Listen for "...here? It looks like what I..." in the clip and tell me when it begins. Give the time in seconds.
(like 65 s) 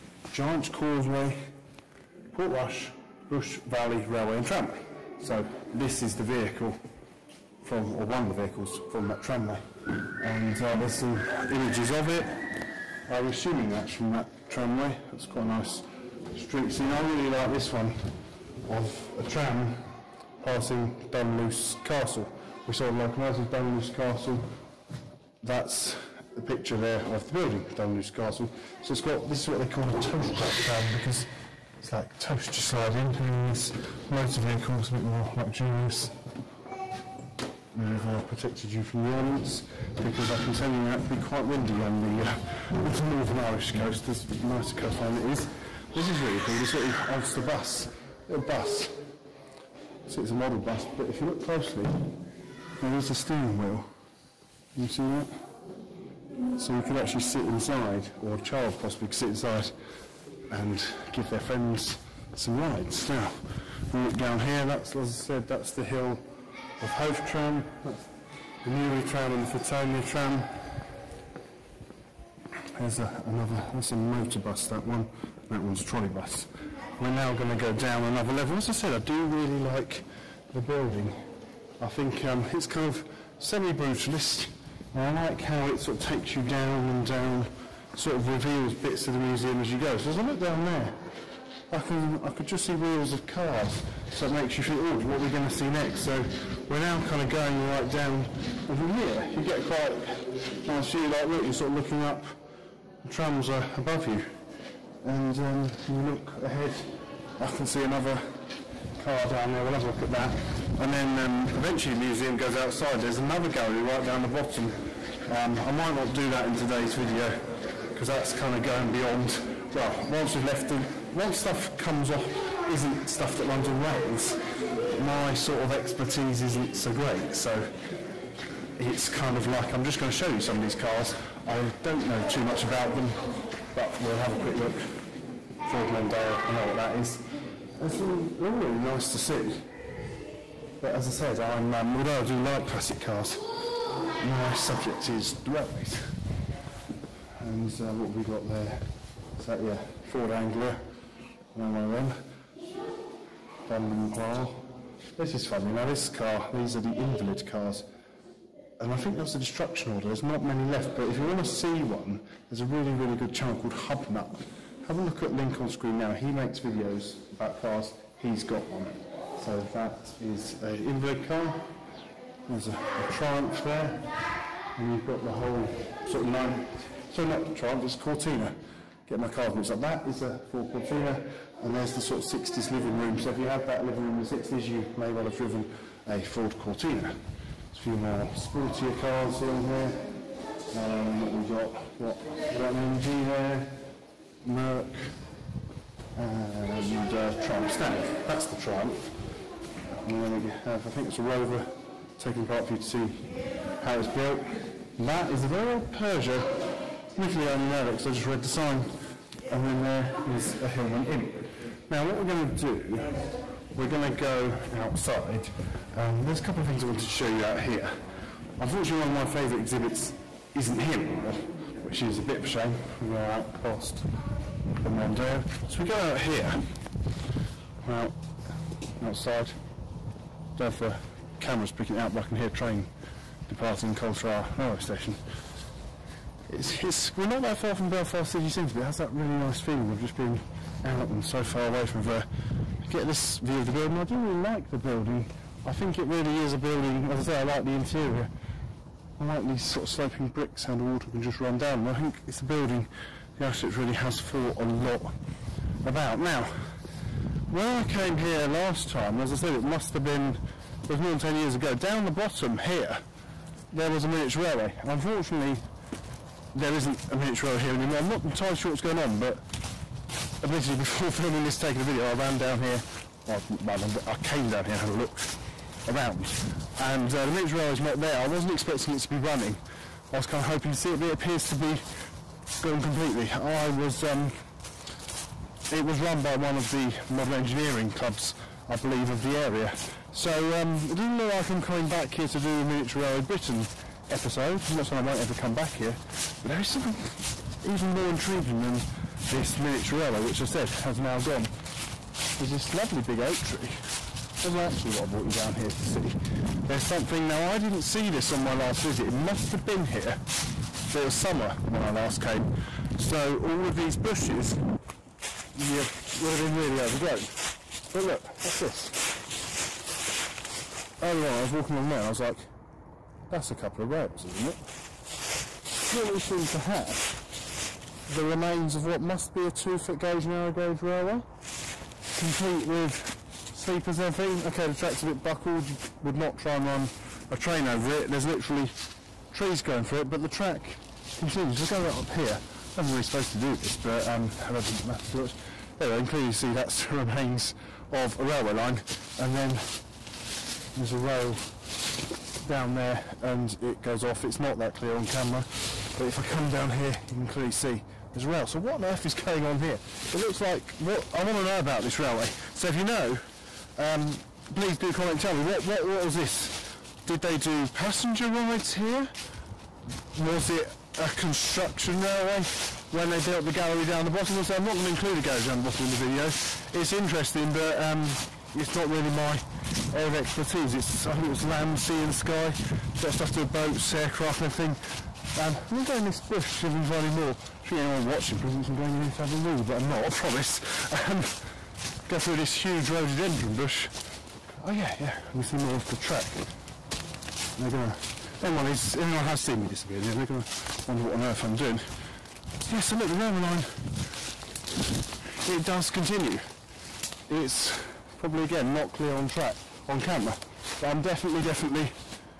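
359 s.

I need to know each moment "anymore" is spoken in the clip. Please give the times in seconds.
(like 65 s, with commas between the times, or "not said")
221 s, 267 s.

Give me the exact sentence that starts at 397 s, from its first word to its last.
They're gonna, anyone is, anyone has seen me disappear, they're gonna wonder what on earth I'm doing.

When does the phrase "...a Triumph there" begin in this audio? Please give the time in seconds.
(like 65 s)
172 s.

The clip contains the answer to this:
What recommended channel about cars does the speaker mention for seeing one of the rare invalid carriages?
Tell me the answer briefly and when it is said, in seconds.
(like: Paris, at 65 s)
Hubnut, at 163 s.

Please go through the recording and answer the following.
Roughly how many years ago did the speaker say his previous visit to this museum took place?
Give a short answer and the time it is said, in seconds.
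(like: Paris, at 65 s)
more than 10 years, at 261 s.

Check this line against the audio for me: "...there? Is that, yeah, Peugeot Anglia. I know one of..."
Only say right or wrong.
wrong.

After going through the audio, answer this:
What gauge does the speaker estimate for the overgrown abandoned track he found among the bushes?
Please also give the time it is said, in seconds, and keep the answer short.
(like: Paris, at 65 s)
2 foot, at 329 s.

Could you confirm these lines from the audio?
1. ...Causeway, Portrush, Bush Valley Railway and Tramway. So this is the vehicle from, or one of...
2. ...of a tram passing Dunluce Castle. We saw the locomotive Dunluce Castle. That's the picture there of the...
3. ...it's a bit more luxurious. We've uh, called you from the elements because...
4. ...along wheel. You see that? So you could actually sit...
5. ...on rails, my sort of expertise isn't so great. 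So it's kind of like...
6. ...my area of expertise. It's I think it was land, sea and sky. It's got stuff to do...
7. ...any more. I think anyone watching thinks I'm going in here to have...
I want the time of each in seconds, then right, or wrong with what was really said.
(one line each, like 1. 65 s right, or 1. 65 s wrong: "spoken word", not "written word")
1. 0 s right
2. 18 s right
3. 34 s wrong: "protected", not "called"
4. 53 s wrong: "steering", not "along"
5. 123 s right
6. 379 s right
7. 387 s right.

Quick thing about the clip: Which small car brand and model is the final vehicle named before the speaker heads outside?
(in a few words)
Hillman Imp.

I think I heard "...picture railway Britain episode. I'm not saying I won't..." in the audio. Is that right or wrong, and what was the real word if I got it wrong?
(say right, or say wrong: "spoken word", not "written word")
wrong: "miniature", not "picture".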